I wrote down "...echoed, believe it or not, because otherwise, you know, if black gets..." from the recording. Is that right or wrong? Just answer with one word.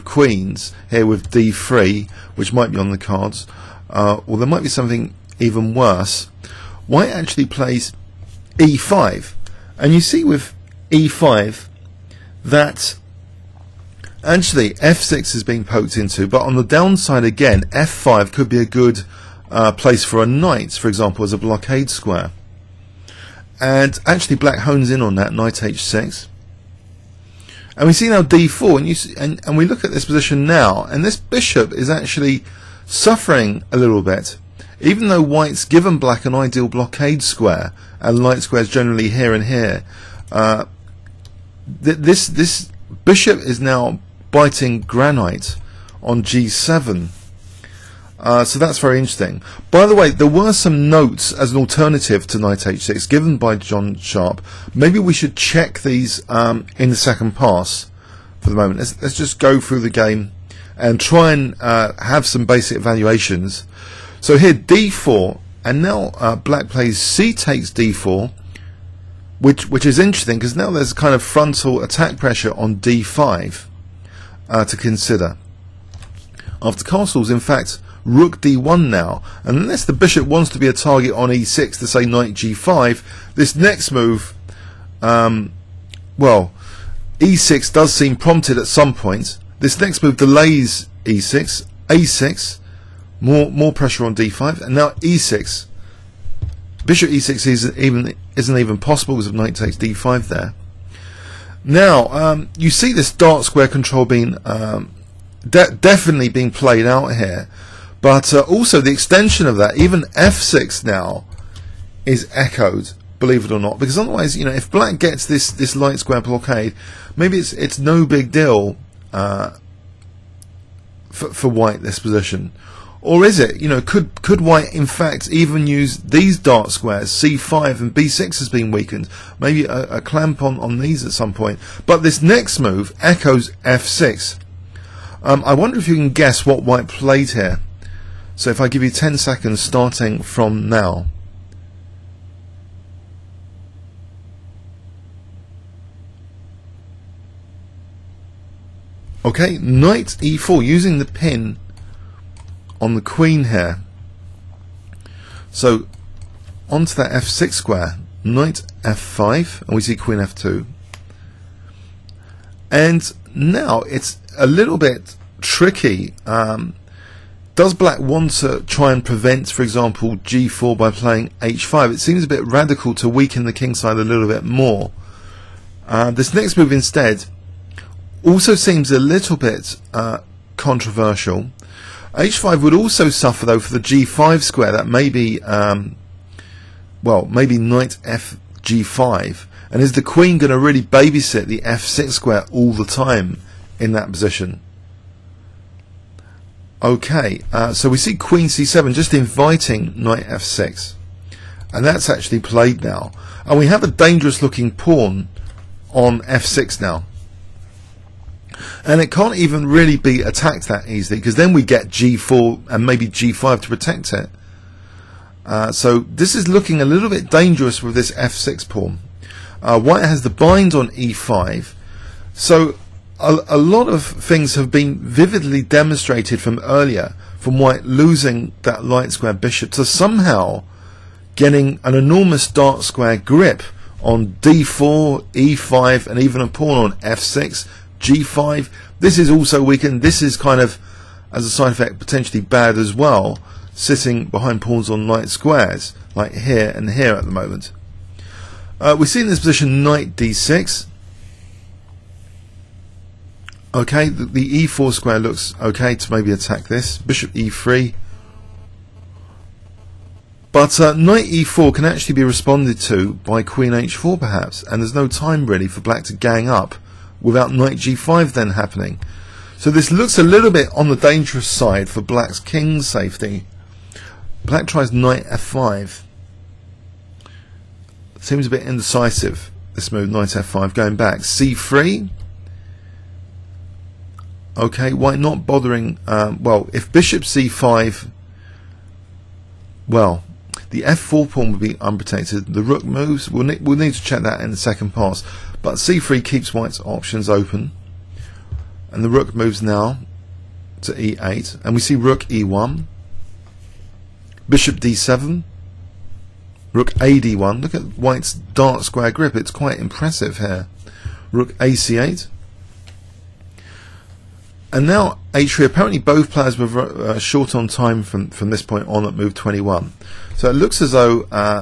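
right.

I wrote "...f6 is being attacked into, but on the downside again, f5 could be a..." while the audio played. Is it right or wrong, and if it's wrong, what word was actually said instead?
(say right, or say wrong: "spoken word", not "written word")
wrong: "poked", not "attacked".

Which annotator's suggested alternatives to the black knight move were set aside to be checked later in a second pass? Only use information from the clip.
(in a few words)
John Sharp.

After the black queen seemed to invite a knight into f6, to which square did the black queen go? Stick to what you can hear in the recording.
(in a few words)
c7.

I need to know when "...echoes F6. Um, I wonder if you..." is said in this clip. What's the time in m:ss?
2:13.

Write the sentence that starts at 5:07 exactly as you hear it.
Look at white's dark square grip.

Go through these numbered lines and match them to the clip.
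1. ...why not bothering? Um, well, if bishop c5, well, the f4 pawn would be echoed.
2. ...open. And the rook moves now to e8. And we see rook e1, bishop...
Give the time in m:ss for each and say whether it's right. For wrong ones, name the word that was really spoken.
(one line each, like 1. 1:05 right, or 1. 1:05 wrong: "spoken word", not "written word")
1. 4:44 wrong: "unprotected", not "echoed"
2. 4:57 right.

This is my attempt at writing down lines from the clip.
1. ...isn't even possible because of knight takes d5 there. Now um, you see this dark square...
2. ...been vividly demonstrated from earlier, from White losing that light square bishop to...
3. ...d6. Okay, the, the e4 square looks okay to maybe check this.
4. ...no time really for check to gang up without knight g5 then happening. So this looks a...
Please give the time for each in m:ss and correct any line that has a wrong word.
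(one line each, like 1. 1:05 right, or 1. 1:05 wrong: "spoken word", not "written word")
1. 1:38 right
2. 3:44 right
3. 4:10 wrong: "attack", not "check"
4. 4:24 wrong: "black", not "check".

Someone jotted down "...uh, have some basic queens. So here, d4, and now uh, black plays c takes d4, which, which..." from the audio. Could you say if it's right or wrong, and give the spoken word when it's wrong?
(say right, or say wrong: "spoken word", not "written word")
wrong: "evaluations", not "queens".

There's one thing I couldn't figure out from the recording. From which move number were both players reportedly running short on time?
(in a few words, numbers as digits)
21.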